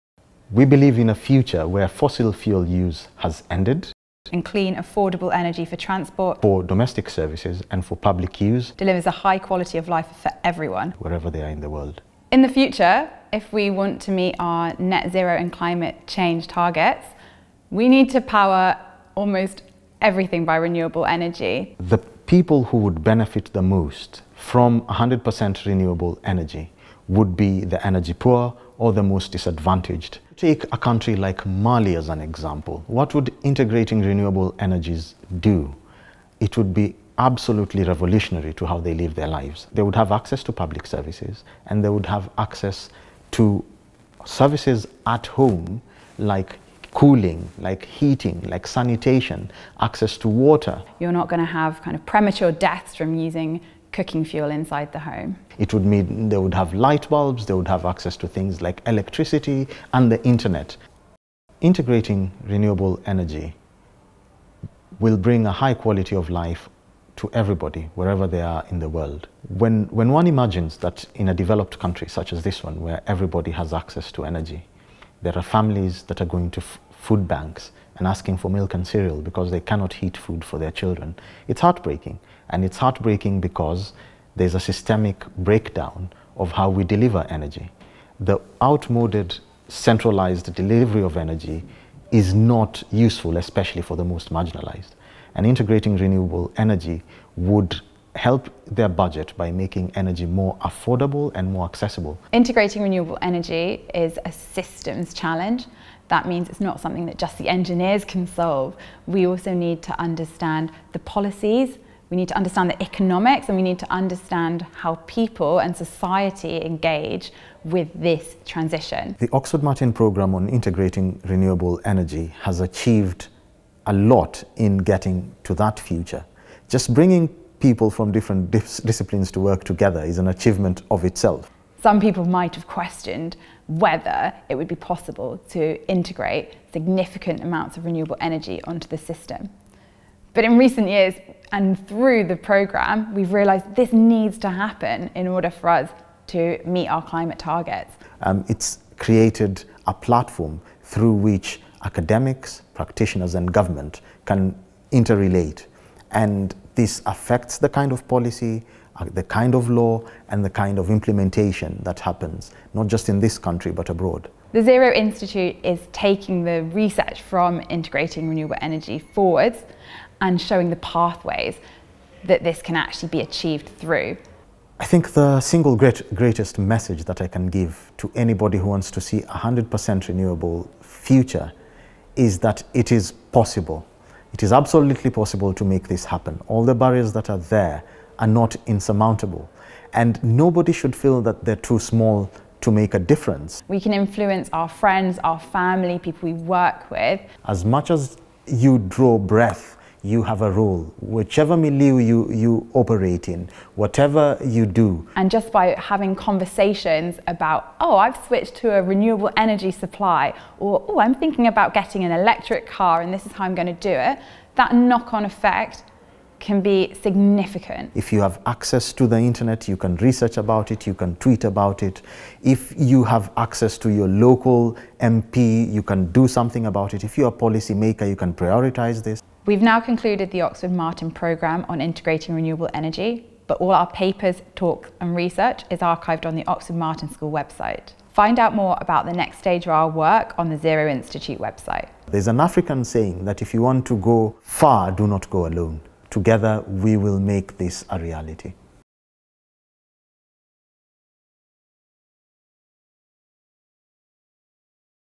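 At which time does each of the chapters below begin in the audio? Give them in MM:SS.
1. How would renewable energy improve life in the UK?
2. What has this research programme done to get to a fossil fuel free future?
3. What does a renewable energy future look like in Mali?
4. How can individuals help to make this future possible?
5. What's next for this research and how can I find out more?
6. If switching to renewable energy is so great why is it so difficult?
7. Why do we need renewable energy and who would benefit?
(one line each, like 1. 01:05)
1. 01:01
2. 01:59
3. 00:30
4. 03:12
5. 03:50
6. 01:42
7. 00:12.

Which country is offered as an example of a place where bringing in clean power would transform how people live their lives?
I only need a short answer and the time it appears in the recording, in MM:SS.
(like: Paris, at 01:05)
Mali, at 00:31.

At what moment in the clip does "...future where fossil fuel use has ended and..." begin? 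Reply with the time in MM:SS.
00:01.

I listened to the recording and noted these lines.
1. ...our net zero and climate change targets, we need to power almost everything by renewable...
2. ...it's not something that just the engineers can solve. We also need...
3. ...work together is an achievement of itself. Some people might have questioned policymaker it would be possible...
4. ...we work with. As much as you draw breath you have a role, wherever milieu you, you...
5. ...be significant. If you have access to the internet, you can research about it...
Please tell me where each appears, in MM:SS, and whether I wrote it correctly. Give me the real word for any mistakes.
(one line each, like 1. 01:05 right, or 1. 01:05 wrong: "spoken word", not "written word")
1. 00:14 right
2. 01:46 right
3. 02:09 wrong: "whether", not "policymaker"
4. 03:16 wrong: "whichever", not "wherever"
5. 03:36 right.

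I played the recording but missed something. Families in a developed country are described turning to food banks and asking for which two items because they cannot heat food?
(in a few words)
Milk and cereal.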